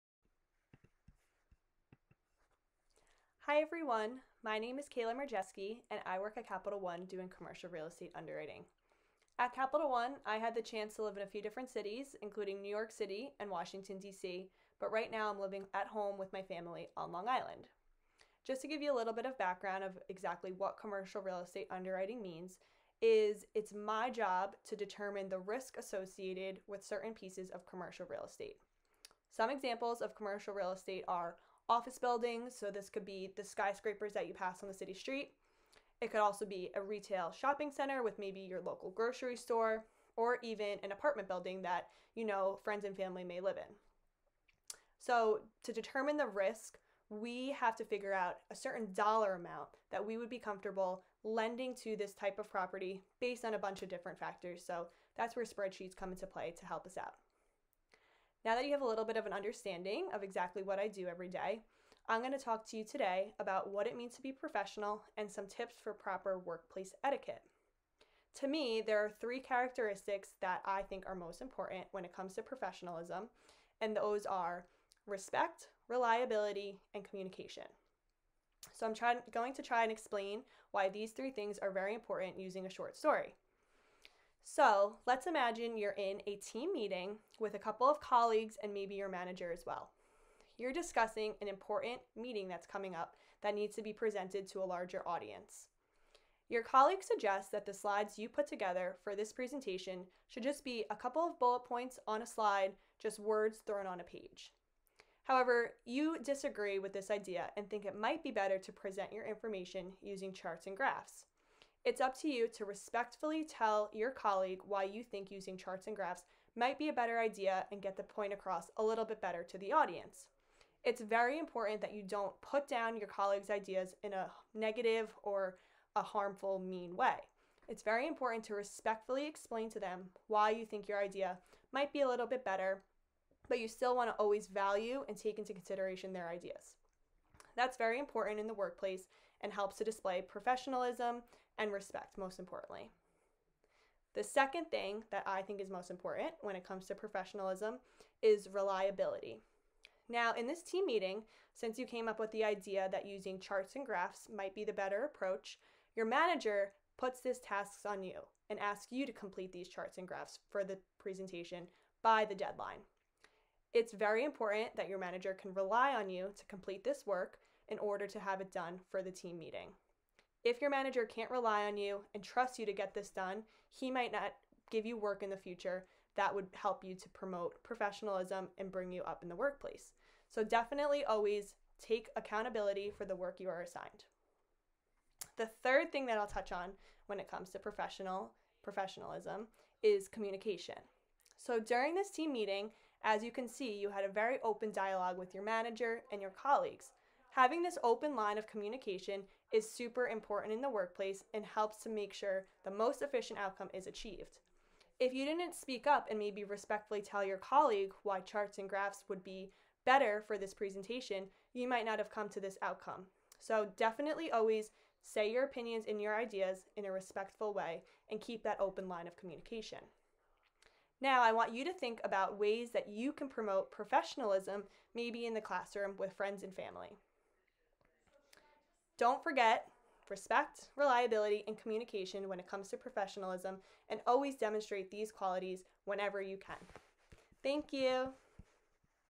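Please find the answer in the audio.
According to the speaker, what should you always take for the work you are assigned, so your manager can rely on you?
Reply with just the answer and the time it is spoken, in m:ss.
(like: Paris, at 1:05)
Accountability, at 3:02.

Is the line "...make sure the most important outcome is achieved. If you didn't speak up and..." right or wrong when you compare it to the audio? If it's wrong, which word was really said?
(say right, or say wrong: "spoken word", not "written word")
wrong: "efficient", not "important".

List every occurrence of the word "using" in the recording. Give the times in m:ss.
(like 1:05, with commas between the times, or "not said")
1:22, 1:50, 1:55, 2:33.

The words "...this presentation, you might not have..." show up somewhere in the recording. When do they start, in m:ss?
3:30.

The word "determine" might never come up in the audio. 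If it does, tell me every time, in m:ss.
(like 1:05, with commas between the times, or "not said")
0:24, 0:45.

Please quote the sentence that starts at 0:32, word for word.
So this could be the skyscrapers that you pass on the city street.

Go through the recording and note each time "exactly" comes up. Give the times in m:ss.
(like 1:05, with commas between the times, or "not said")
0:20, 1:00.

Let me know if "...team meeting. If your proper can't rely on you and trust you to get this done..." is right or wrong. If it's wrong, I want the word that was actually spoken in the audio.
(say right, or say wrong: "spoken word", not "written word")
wrong: "manager", not "proper".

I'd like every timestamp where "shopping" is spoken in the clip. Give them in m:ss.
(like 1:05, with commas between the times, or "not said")
0:37.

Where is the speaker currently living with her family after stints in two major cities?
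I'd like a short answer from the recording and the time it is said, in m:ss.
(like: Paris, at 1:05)
Long Island, at 0:17.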